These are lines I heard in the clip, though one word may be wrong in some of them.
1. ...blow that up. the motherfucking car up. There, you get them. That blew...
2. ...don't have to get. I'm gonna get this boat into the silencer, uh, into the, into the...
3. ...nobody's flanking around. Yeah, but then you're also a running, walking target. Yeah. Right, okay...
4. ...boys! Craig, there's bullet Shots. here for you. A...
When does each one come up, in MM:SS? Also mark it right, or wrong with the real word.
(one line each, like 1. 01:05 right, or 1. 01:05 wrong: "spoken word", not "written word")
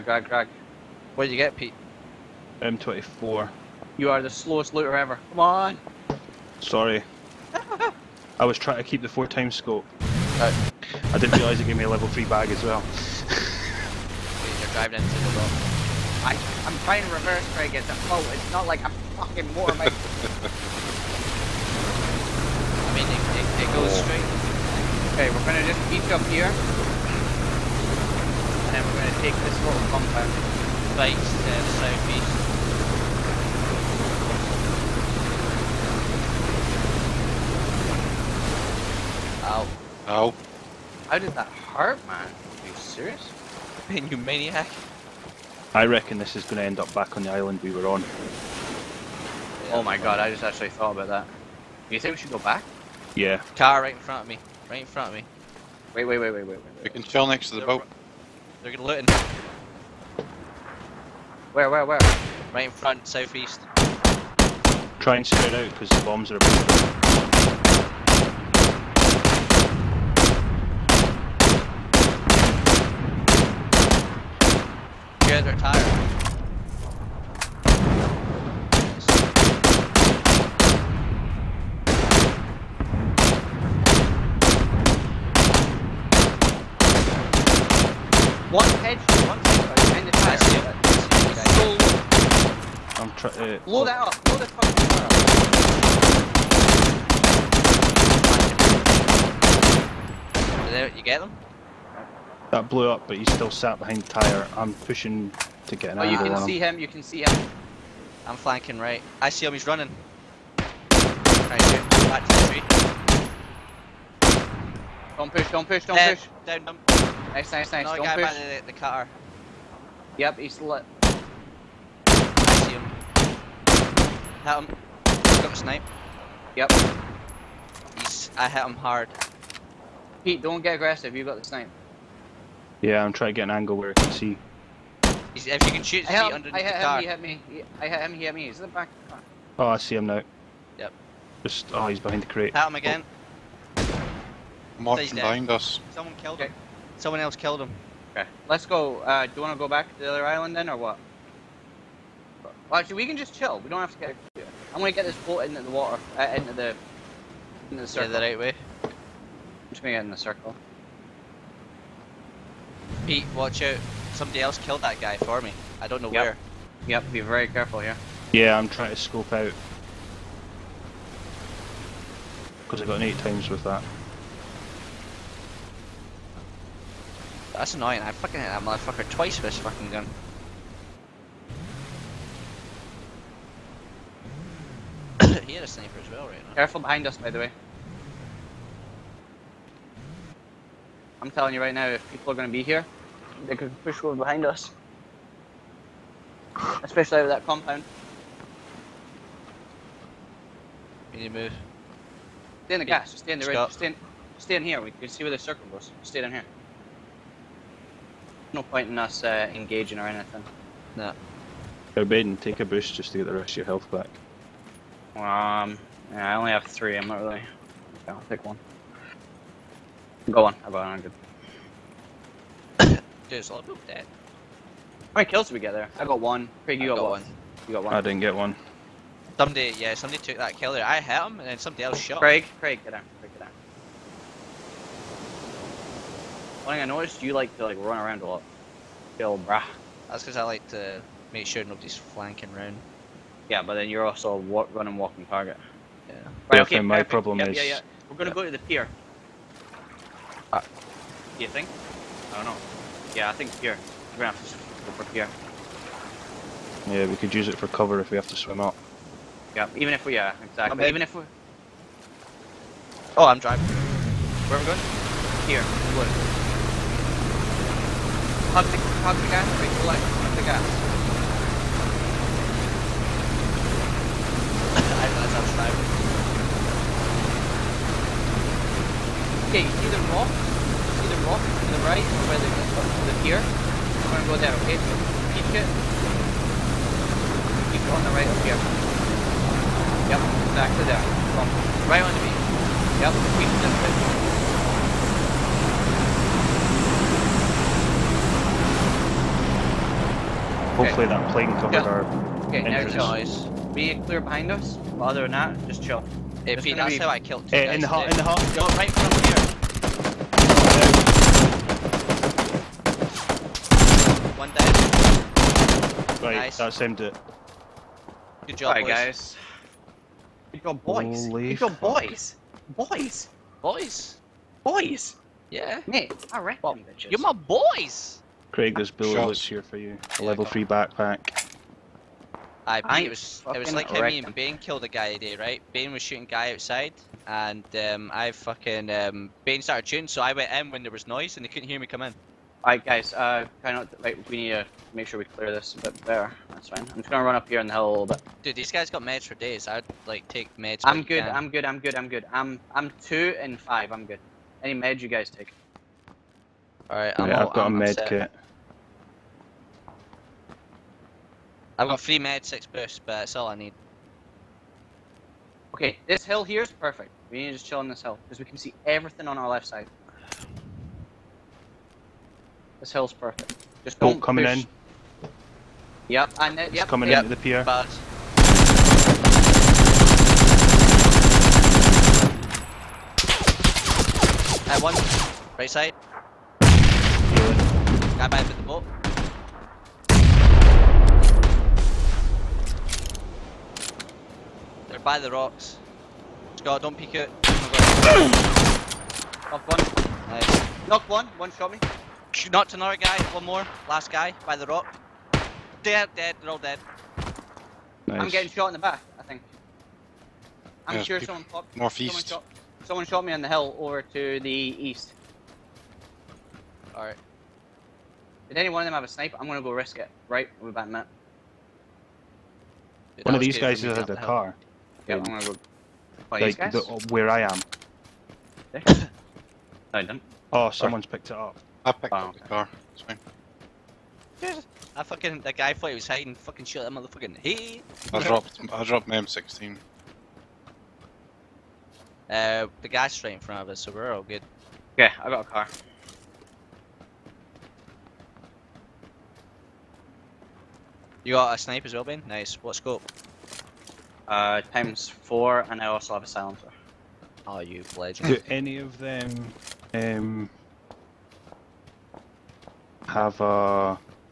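1. 01:33 wrong: "fucking", not "motherfucking"
2. 02:33 wrong: "water", not "silencer"
3. 04:01 right
4. 05:27 right.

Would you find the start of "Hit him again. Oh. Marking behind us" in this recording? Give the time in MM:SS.
02:22.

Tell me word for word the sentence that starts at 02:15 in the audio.
He's, if you can shoot his feet underneath I hit him, car.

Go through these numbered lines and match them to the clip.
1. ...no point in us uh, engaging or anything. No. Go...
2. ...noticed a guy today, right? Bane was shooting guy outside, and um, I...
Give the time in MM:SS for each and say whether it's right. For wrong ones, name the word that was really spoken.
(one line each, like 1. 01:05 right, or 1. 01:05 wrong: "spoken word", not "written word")
1. 03:28 right
2. 05:34 wrong: "killed", not "noticed".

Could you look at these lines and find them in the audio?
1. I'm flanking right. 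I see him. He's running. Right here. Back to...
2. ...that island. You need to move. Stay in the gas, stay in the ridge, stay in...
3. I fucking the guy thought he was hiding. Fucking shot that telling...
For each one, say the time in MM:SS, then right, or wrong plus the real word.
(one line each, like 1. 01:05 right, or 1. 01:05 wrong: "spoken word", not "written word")
1. 01:48 right
2. 03:17 wrong: "compound", not "island"
3. 07:14 wrong: "motherfucking", not "telling".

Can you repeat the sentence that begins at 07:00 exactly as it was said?
Right, we'll be back in a minute.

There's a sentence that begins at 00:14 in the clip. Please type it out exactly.
You're driving into the I, I'm trying to reverse try to get the float.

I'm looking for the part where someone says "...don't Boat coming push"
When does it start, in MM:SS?
06:13.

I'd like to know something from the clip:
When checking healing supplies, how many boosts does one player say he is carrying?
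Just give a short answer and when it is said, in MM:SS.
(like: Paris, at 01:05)
6, at 06:02.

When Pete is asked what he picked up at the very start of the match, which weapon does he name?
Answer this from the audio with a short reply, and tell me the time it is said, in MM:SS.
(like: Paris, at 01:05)
M24, at 00:02.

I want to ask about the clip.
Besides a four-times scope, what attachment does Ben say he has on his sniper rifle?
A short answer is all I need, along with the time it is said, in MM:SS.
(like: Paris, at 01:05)
silencer, at 07:36.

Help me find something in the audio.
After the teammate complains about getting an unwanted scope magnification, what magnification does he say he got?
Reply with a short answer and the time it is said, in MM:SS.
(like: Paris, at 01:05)
8 times, at 02:53.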